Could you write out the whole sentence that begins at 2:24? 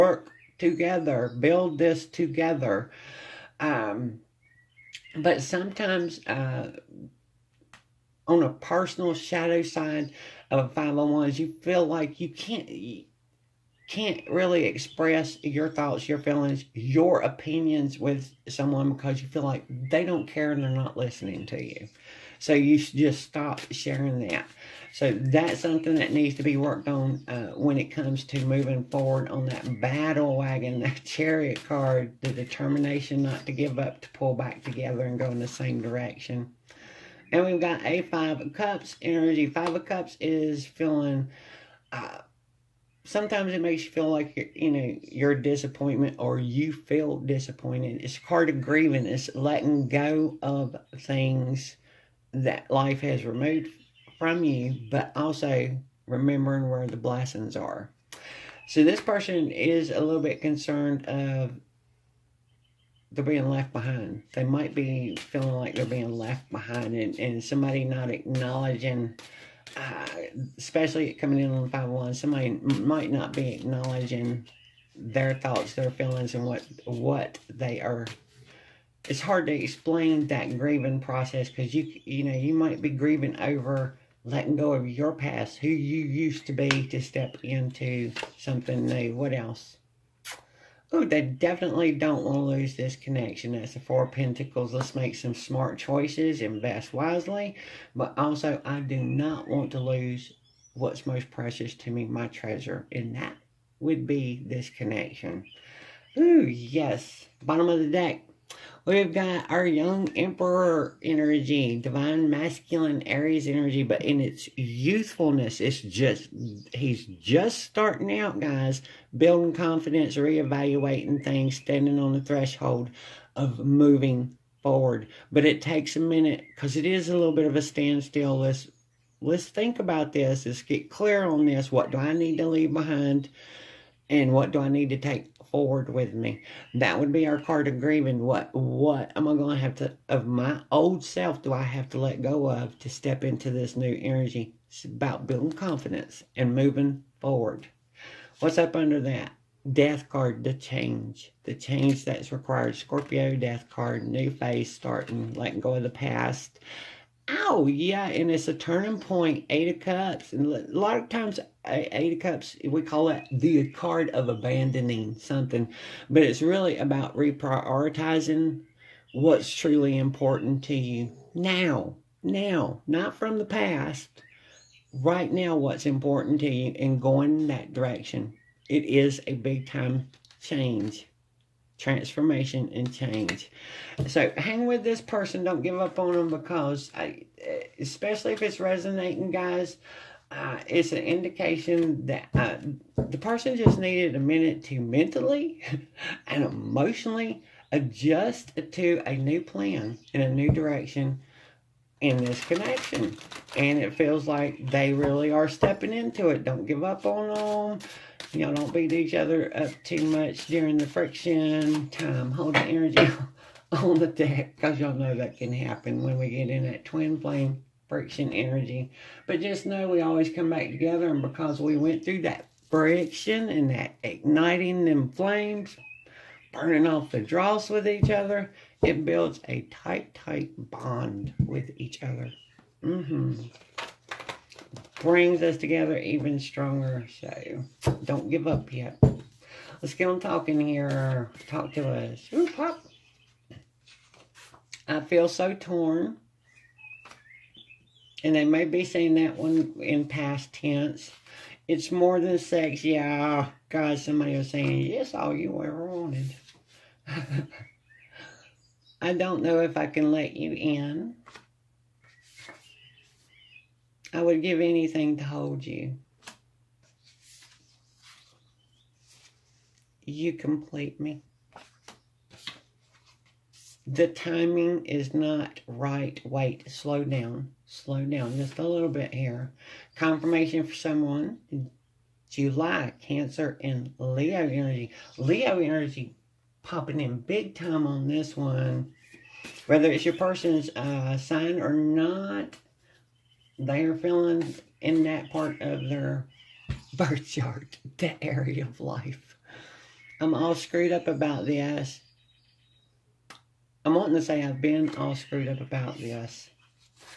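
It's about building confidence and moving forward.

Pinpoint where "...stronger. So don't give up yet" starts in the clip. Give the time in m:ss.
3:56.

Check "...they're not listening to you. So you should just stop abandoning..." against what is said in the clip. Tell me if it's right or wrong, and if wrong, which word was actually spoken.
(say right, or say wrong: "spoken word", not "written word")
wrong: "sharing", not "abandoning".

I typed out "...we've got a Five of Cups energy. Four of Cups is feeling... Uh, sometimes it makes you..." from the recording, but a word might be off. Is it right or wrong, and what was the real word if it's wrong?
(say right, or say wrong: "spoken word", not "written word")
wrong: "Five", not "Four".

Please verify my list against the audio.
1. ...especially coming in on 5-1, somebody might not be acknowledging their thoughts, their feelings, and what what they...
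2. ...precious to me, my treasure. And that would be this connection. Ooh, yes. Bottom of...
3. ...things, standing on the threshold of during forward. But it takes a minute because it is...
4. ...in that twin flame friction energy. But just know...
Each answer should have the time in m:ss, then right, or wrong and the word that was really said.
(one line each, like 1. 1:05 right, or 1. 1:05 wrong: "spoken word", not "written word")
1. 1:10 right
2. 1:41 right
3. 2:01 wrong: "moving", not "during"
4. 3:36 right.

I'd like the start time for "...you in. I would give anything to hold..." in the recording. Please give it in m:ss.
4:20.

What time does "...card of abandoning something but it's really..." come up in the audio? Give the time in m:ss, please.
2:43.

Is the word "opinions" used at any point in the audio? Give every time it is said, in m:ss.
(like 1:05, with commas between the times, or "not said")
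0:17.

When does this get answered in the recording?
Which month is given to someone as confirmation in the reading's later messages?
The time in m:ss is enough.
4:42.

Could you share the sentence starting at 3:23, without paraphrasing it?
And it feels like they really are stepping into it.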